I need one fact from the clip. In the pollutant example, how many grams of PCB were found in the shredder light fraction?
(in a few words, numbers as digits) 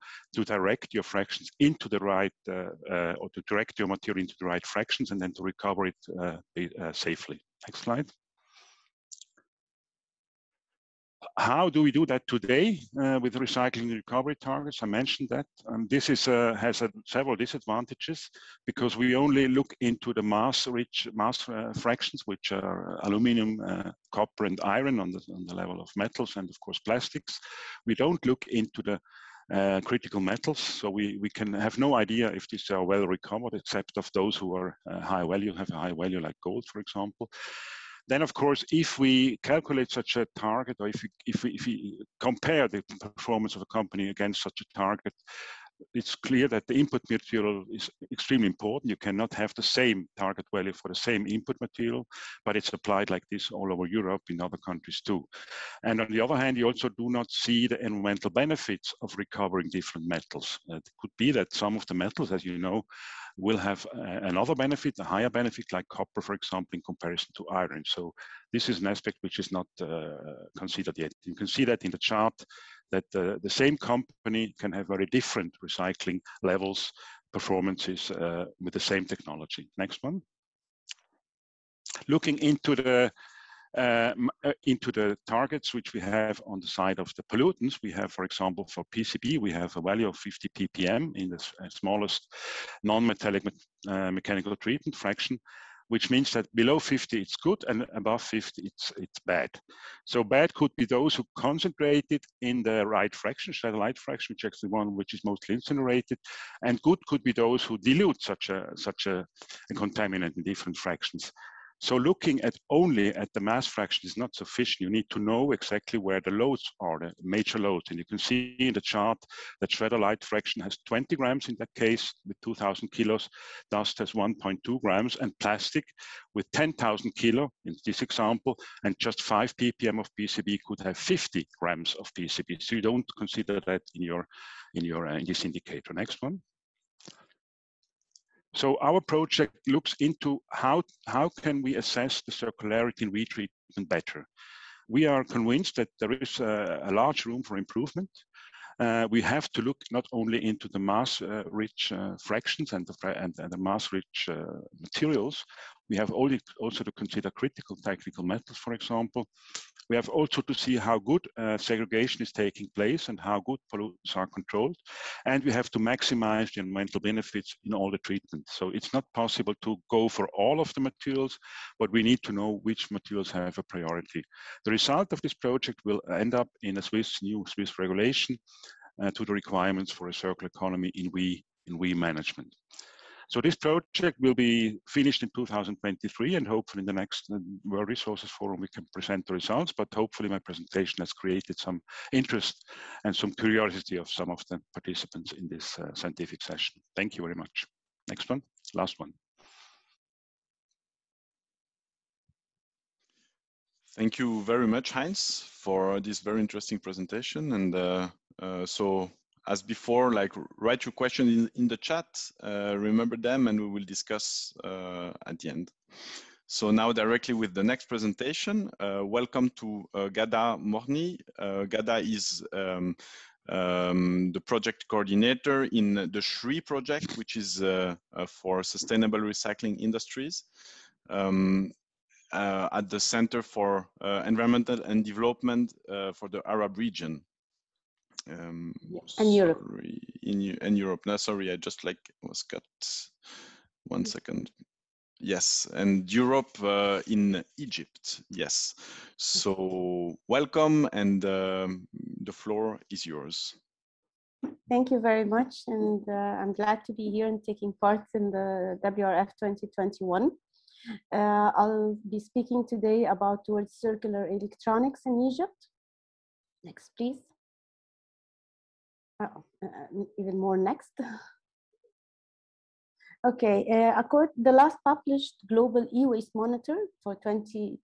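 20 grams.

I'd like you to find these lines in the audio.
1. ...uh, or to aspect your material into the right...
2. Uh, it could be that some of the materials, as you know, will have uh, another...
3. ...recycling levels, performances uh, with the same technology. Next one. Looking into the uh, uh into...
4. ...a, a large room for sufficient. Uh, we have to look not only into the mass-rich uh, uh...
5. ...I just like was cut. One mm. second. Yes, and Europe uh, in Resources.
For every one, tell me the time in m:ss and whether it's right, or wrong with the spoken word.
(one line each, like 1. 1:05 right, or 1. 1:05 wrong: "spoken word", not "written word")
1. 0:02 wrong: "direct", not "aspect"
2. 1:00 wrong: "metals", not "materials"
3. 1:15 right
4. 2:26 wrong: "improvement", not "sufficient"
5. 4:01 wrong: "Egypt", not "Resources".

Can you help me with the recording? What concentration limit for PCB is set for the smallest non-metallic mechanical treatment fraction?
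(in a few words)
50 ppm.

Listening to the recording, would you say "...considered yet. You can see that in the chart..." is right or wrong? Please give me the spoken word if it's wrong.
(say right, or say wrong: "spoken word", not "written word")
right.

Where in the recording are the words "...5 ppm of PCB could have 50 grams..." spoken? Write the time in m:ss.
2:09.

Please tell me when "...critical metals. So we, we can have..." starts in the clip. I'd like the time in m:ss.
0:29.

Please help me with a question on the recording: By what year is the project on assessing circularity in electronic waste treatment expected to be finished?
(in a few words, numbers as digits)
2023.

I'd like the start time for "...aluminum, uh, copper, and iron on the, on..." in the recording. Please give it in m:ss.
0:23.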